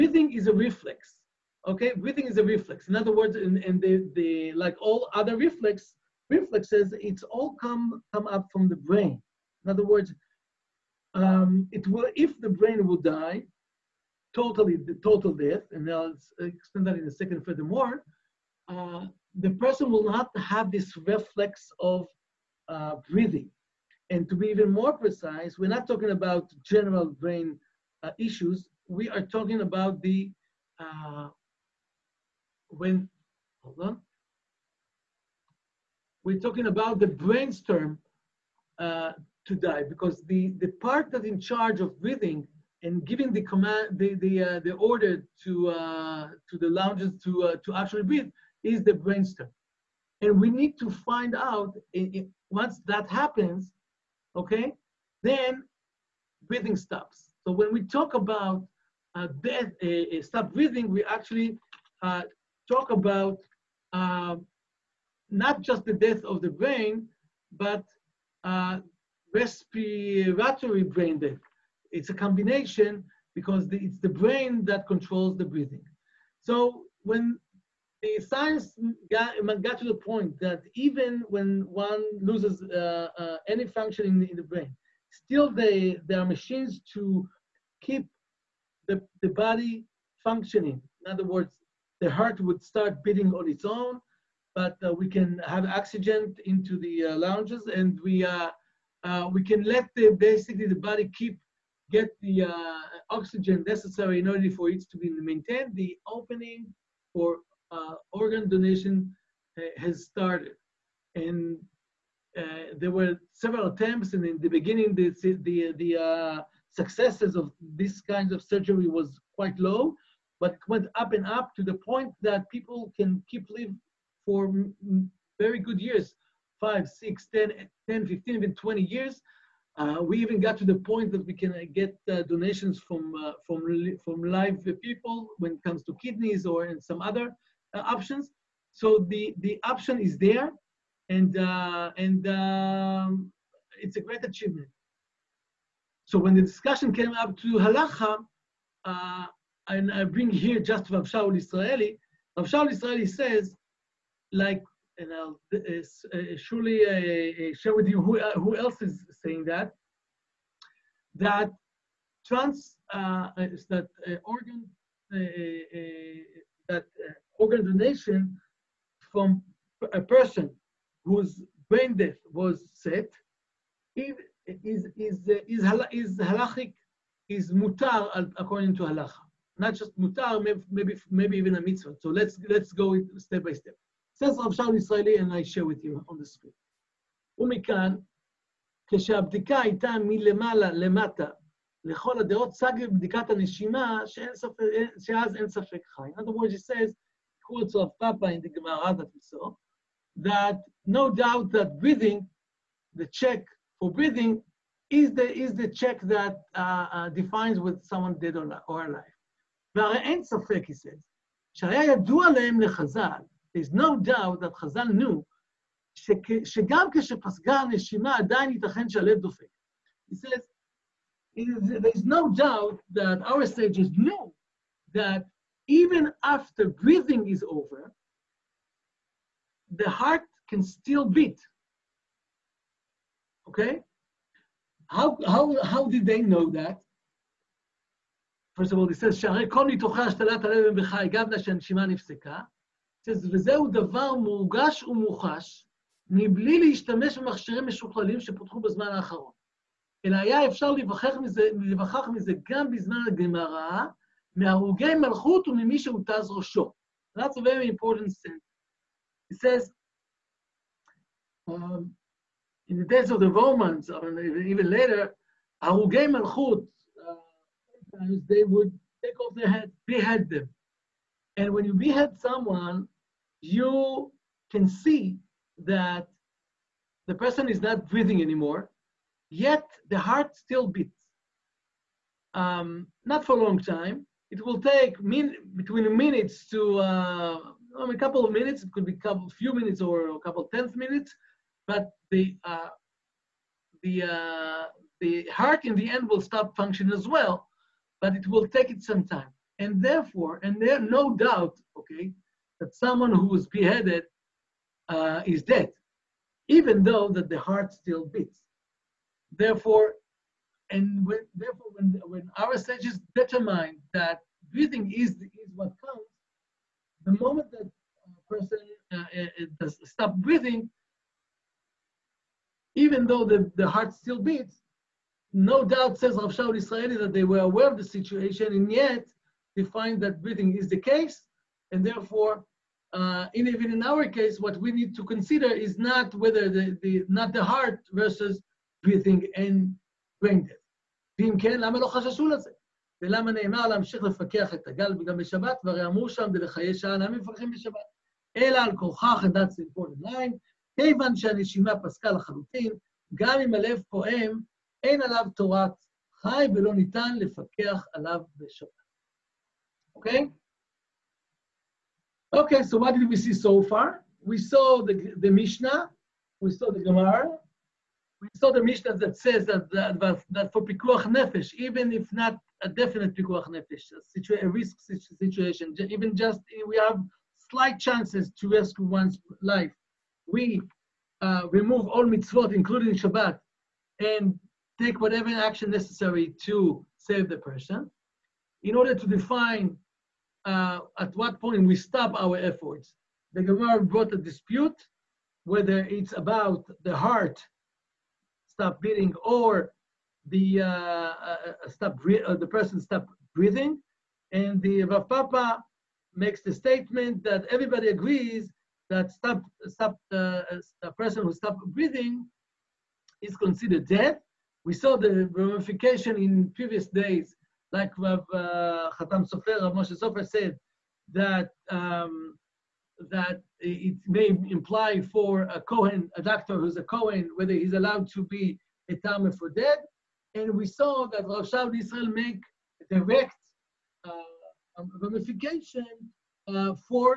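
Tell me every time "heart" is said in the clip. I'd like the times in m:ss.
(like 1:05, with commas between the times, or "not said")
1:32, 3:49, 4:39, 4:55, 5:07, 5:23, 5:37, 6:36.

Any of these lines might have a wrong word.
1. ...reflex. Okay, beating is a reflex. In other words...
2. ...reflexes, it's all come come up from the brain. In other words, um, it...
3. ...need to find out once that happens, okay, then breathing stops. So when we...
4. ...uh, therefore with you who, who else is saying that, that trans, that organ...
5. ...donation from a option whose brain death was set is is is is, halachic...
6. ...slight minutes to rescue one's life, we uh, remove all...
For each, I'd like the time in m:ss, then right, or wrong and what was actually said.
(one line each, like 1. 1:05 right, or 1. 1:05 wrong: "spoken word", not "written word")
1. 0:00 wrong: "breathing", not "beating"
2. 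0:06 right
3. 0:50 right
4. 2:37 wrong: "share", not "therefore"
5. 2:47 wrong: "person", not "option"
6. 6:17 wrong: "chances", not "minutes".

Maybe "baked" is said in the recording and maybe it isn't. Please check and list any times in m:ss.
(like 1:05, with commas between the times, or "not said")
not said.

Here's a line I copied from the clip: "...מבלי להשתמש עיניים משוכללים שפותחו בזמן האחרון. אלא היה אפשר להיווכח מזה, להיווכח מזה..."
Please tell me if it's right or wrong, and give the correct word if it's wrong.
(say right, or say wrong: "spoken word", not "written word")
wrong: "במכשירים", not "עיניים".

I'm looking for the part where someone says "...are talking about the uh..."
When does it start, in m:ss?
0:29.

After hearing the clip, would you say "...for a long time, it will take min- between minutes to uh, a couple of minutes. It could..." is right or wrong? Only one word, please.
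right.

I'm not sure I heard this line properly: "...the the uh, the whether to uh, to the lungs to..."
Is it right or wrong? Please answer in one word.
wrong.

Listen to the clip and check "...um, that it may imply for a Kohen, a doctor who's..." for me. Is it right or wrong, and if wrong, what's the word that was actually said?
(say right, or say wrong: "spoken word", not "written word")
right.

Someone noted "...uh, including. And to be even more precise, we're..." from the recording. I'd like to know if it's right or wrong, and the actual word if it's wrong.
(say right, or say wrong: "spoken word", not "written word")
wrong: "breathing", not "including".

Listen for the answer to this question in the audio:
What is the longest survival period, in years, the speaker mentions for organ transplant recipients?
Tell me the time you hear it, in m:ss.
2:08.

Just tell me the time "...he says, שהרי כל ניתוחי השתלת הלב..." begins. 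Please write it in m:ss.
3:58.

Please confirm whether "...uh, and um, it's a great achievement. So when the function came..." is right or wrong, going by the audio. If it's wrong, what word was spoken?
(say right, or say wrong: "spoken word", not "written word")
wrong: "discussion", not "function".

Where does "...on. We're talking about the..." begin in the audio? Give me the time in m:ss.
0:33.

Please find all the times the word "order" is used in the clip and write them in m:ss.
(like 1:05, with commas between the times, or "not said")
0:44, 1:44, 6:28.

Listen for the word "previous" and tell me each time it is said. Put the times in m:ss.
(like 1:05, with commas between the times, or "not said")
6:56.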